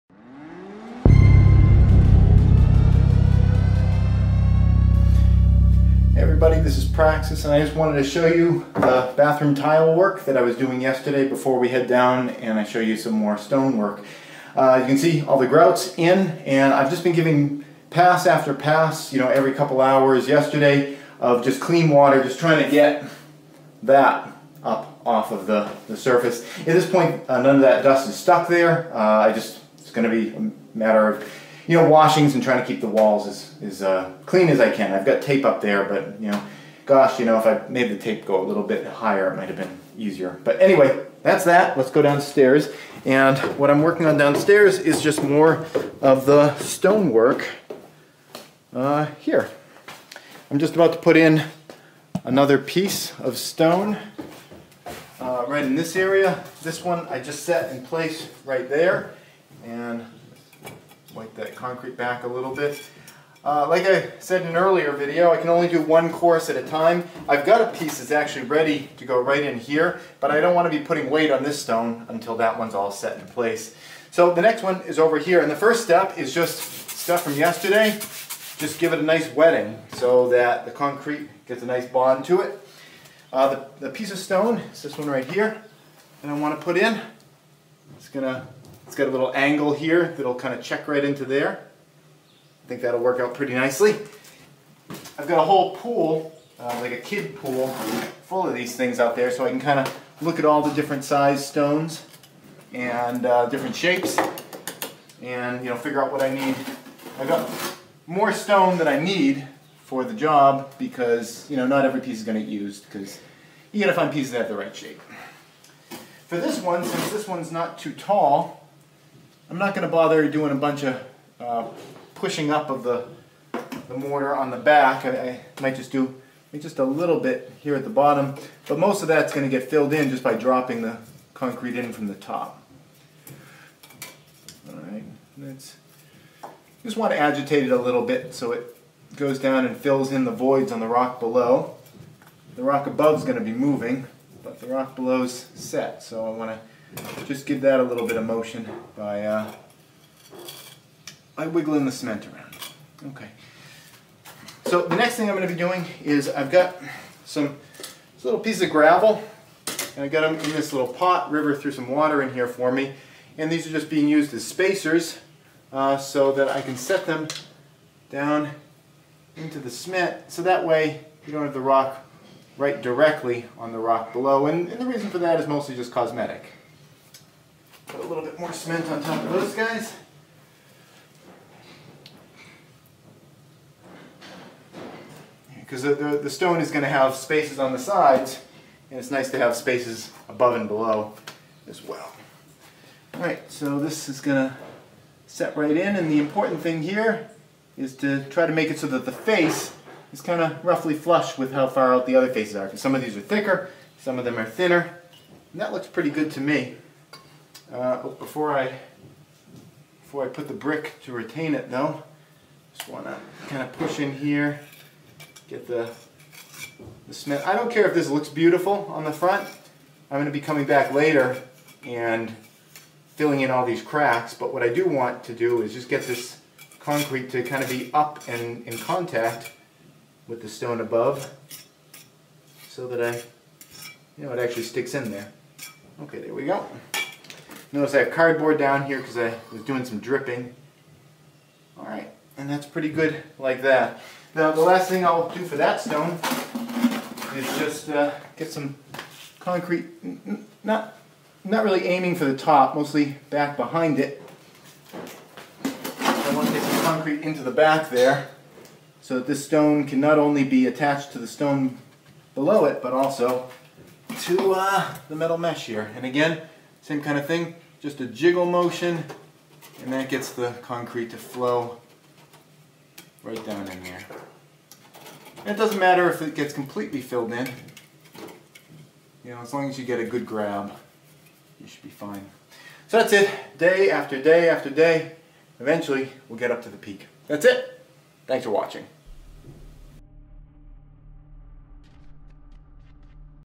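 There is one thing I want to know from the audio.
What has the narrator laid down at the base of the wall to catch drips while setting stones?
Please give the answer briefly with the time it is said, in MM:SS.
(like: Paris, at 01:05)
cardboard, at 03:58.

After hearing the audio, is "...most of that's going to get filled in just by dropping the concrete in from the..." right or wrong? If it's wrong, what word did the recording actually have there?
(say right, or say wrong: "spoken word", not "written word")
right.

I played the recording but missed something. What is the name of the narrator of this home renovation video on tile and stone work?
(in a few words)
Praxis.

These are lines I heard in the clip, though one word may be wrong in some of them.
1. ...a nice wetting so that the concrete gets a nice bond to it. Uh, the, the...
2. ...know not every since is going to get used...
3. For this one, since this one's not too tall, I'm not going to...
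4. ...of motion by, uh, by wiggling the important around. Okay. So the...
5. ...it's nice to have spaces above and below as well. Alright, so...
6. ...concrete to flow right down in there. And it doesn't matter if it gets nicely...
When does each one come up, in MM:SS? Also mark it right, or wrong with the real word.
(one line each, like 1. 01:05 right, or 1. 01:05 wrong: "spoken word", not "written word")
1. 01:18 right
2. 01:51 wrong: "piece", not "since"
3. 01:56 right
4. 02:28 wrong: "cement", not "important"
5. 03:08 right
6. 04:30 wrong: "completely", not "nicely".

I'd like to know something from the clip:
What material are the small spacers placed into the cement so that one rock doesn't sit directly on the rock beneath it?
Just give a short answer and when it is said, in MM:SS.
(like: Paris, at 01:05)
gravel, at 02:38.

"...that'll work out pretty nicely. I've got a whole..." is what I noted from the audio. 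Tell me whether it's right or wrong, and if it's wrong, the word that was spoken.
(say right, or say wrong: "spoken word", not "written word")
right.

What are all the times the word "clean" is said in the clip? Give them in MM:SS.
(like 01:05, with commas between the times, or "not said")
00:21, 00:34.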